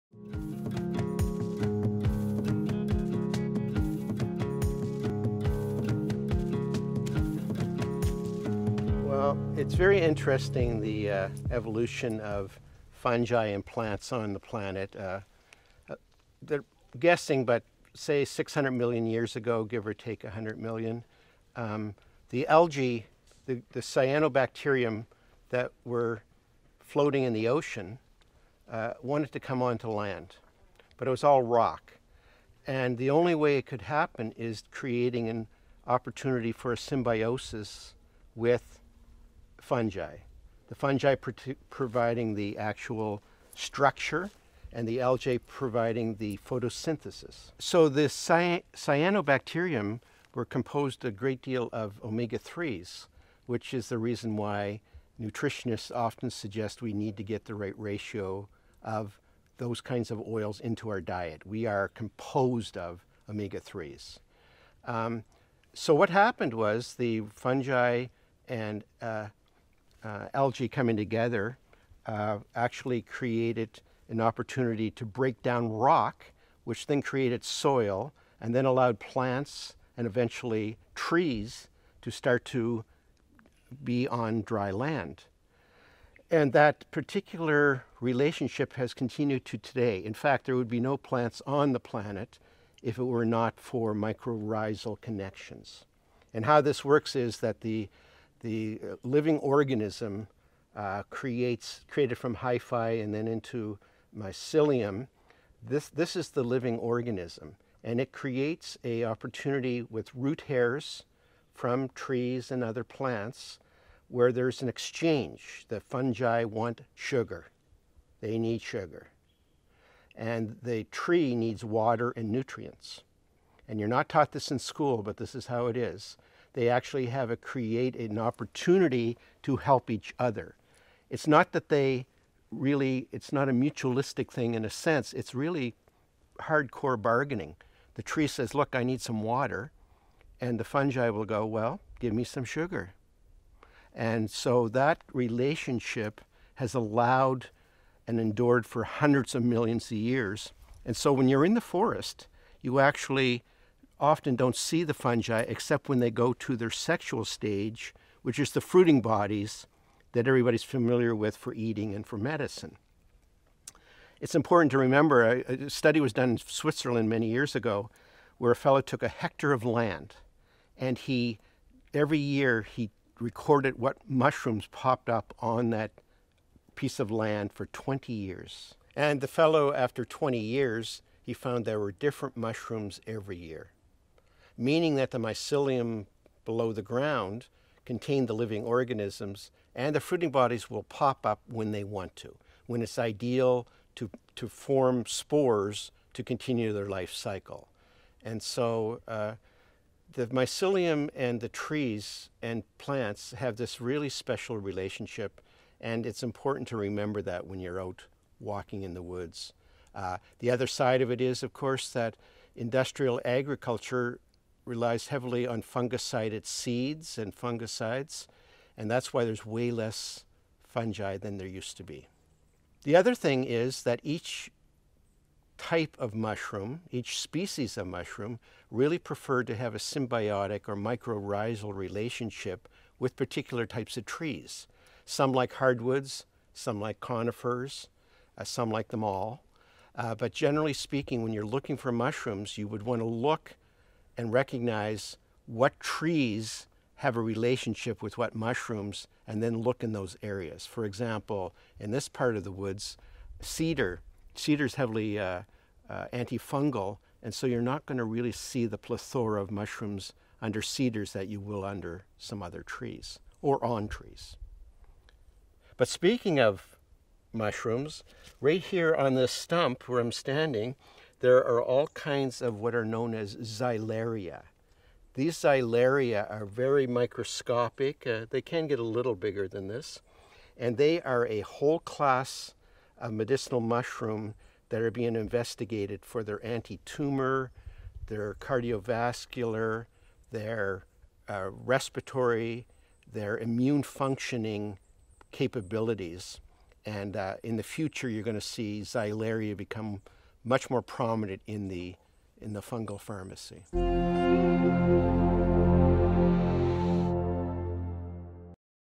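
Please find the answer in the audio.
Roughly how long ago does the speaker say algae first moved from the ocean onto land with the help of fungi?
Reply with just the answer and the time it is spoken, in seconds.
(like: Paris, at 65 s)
600 million years ago, at 18 s.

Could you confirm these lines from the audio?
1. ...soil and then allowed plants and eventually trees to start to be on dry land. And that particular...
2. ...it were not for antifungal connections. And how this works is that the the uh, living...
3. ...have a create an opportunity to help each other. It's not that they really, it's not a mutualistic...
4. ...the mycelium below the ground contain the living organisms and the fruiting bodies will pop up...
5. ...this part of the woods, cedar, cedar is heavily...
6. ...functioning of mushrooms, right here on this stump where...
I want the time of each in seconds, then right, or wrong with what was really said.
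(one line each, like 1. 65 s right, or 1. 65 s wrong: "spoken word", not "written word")
1. 77 s right
2. 92 s wrong: "mycorrhizal", not "antifungal"
3. 127 s right
4. 185 s right
5. 251 s right
6. 265 s wrong: "speaking", not "functioning".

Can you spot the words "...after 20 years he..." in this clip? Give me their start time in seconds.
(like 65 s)
179 s.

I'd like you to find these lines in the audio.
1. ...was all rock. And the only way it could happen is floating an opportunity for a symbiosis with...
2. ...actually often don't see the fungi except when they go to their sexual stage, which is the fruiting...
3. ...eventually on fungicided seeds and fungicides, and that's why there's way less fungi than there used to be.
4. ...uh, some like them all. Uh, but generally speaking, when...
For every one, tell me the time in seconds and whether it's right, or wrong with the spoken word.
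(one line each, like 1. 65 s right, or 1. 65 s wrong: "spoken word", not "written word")
1. 31 s wrong: "creating", not "floating"
2. 152 s right
3. 215 s wrong: "heavily", not "eventually"
4. 238 s right.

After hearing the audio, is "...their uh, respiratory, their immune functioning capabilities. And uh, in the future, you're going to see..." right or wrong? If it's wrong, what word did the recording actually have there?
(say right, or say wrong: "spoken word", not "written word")
right.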